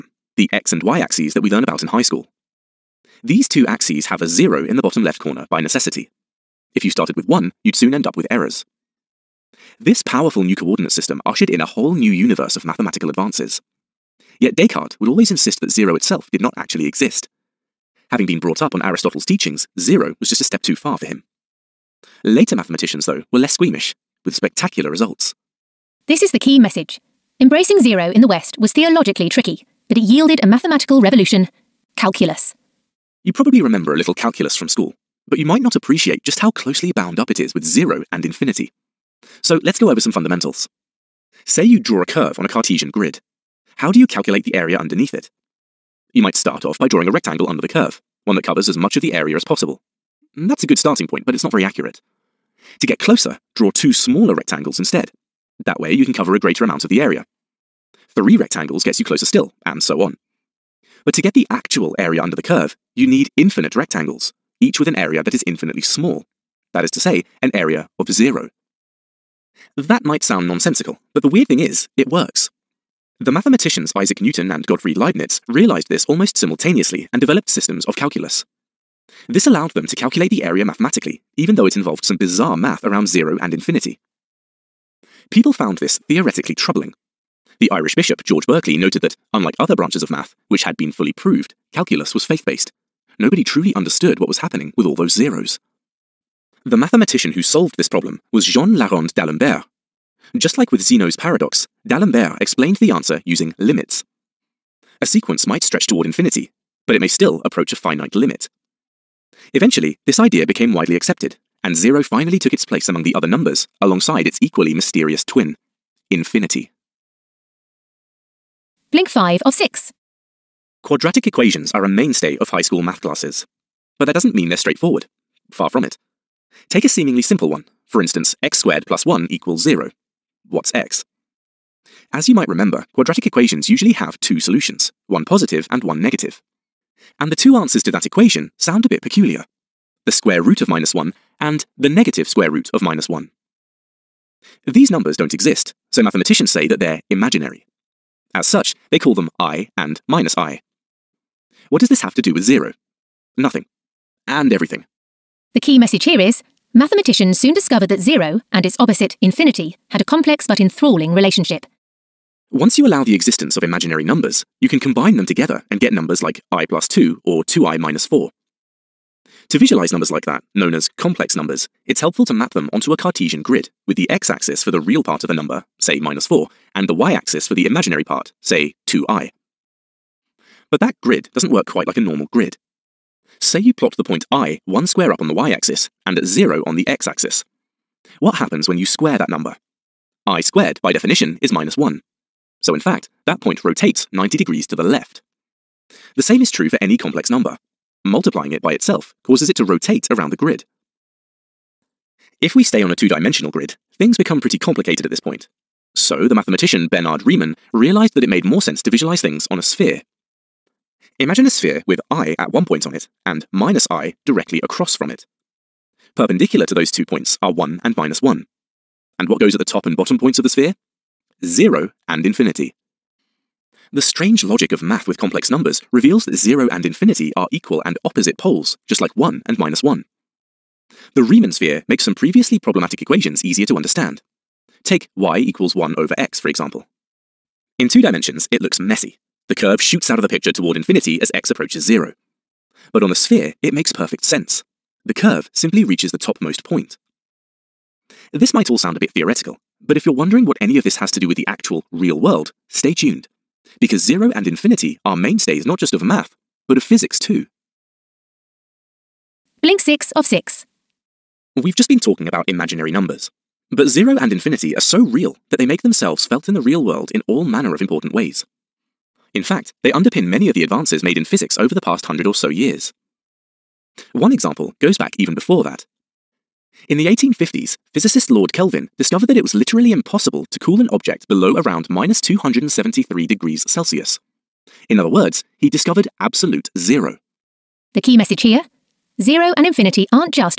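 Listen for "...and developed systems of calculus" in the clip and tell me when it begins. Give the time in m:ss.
1:17.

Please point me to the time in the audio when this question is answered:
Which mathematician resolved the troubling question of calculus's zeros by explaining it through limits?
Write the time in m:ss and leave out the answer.
1:38.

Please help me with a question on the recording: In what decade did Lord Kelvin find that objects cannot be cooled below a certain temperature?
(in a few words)
1850s.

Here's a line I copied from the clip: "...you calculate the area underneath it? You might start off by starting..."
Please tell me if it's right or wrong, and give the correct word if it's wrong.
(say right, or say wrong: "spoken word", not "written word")
wrong: "drawing", not "starting".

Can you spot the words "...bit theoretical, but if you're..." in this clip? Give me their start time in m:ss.
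4:08.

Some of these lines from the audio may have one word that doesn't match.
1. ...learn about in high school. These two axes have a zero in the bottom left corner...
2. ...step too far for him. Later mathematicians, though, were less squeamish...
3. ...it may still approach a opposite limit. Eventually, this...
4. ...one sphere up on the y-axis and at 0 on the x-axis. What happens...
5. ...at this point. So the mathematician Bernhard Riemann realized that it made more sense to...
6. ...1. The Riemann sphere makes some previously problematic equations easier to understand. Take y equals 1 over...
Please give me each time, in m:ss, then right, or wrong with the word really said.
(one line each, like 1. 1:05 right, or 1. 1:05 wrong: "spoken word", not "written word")
1. 0:01 right
2. 0:20 right
3. 1:46 wrong: "finite", not "opposite"
4. 3:04 wrong: "square", not "sphere"
5. 3:25 right
6. 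3:49 right.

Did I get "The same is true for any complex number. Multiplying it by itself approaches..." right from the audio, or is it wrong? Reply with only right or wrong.
wrong.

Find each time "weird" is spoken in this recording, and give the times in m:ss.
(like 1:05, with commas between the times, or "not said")
1:11.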